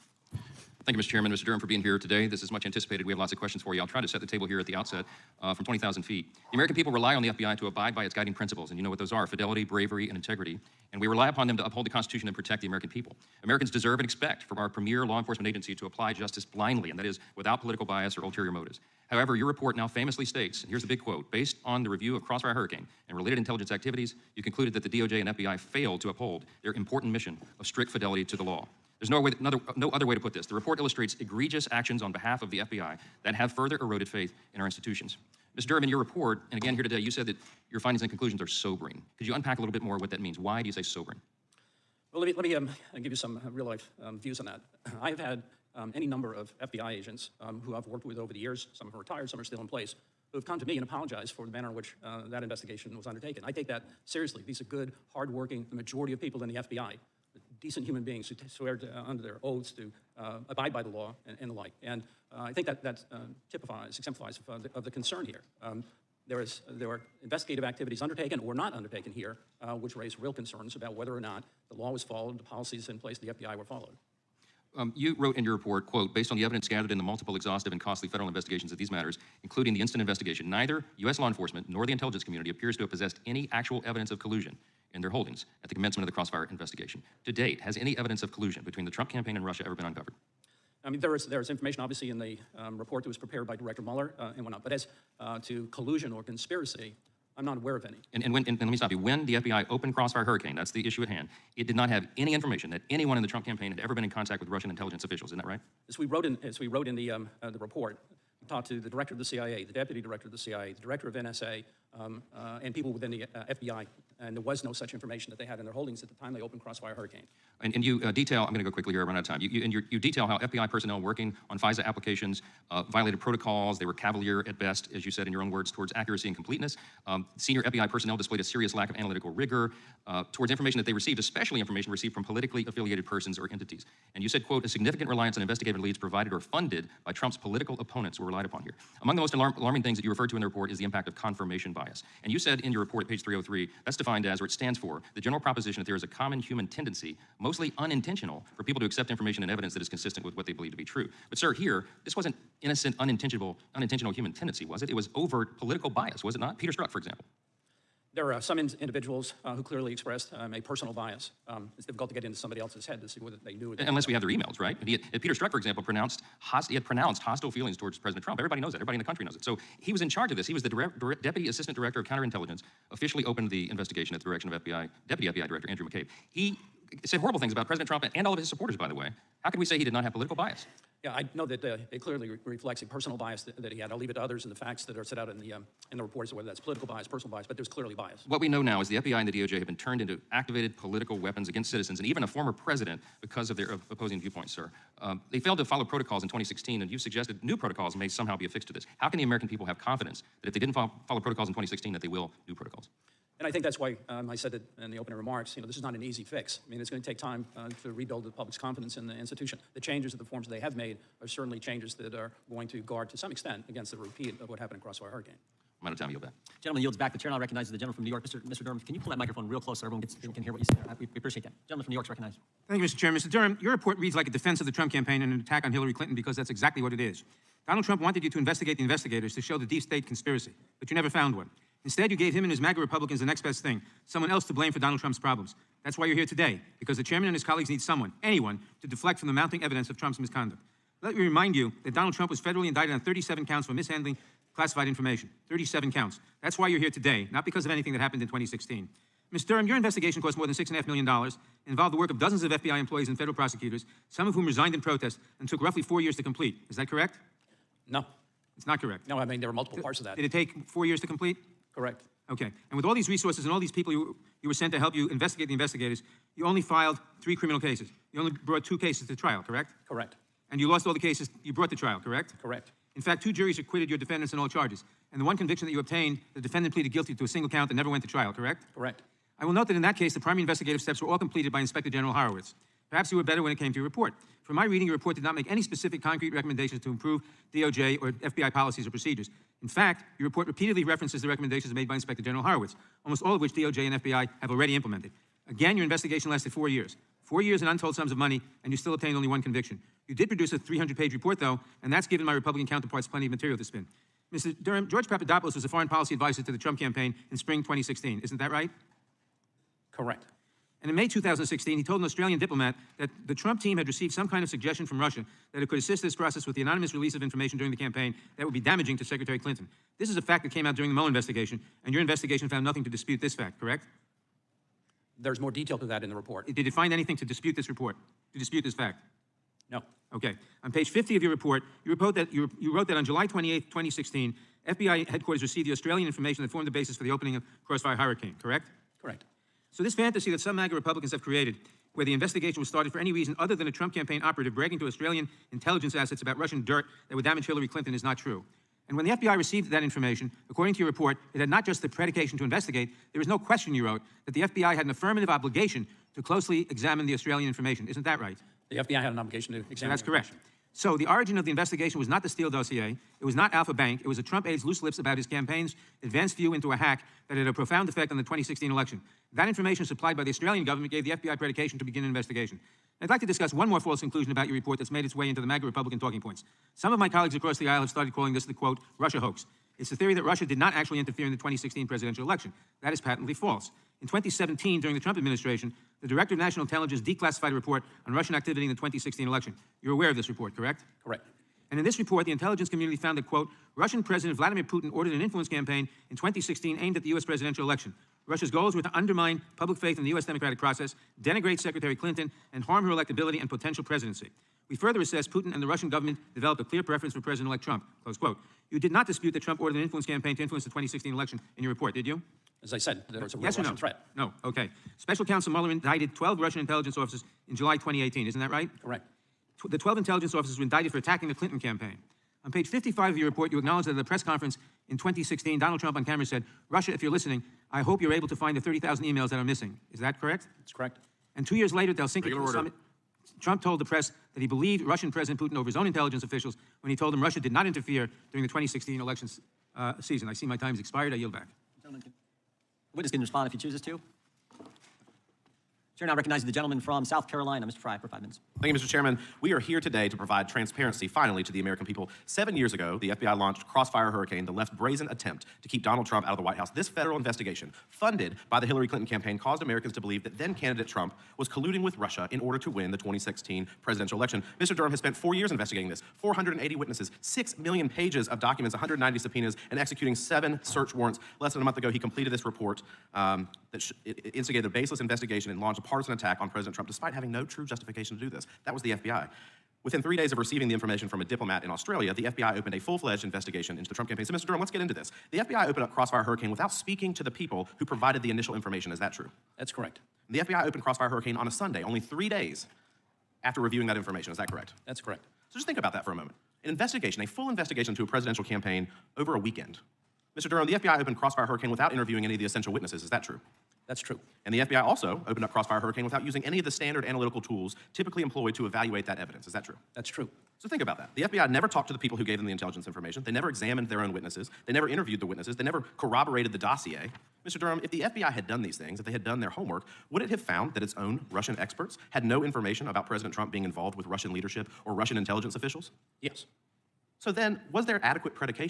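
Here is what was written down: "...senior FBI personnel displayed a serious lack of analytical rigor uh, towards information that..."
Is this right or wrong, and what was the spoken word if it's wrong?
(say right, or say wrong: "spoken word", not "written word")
right.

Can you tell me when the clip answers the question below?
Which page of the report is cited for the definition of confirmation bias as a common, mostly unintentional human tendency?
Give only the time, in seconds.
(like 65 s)
143 s.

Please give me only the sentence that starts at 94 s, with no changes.
But as uh, to collusion or conspiracy, I'm not aware of any.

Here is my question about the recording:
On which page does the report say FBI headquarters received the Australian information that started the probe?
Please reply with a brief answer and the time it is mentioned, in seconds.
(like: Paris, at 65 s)
50, at 330 s.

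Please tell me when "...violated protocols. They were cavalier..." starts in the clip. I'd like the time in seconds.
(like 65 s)
122 s.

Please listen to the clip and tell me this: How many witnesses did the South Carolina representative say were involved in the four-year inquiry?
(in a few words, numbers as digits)
480.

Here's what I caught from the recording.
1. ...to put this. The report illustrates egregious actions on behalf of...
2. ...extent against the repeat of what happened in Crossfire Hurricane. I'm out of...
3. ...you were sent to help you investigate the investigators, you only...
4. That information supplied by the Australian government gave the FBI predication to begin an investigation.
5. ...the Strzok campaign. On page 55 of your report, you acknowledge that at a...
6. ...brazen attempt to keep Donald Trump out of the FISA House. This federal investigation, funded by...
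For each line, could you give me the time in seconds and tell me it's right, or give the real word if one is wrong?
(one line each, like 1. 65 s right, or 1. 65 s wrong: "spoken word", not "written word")
1. 30 s right
2. 213 s right
3. 264 s right
4. 369 s right
5. 421 s wrong: "Clinton", not "Strzok"
6. 454 s wrong: "White", not "FISA".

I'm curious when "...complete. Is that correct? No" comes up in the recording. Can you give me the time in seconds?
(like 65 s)
256 s.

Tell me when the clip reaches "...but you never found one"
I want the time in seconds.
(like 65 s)
230 s.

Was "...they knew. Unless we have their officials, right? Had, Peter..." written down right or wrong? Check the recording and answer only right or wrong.
wrong.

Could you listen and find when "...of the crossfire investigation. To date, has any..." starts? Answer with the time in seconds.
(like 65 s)
86 s.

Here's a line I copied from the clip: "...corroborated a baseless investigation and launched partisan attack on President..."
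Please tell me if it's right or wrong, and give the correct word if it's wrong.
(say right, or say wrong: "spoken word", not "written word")
wrong: "instigated", not "corroborated".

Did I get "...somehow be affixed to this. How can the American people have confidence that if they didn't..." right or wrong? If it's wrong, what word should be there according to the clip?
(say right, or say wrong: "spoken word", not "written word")
right.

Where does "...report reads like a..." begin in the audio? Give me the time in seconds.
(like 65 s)
223 s.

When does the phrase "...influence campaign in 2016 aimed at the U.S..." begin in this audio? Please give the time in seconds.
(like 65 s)
395 s.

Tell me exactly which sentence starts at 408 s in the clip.
You did not dispute that Trump ordered an influence campaign to influence the 2016 election in your report, did you?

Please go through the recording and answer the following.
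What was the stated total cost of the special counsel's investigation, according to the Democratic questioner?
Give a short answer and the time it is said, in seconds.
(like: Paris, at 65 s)
$6.5 million, at 250 s.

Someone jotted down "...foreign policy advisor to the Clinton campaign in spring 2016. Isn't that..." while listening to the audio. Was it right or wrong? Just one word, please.
wrong.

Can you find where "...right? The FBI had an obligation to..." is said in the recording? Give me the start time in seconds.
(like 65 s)
358 s.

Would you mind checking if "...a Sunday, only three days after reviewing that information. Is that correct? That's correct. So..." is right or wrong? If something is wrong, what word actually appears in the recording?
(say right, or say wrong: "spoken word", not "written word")
right.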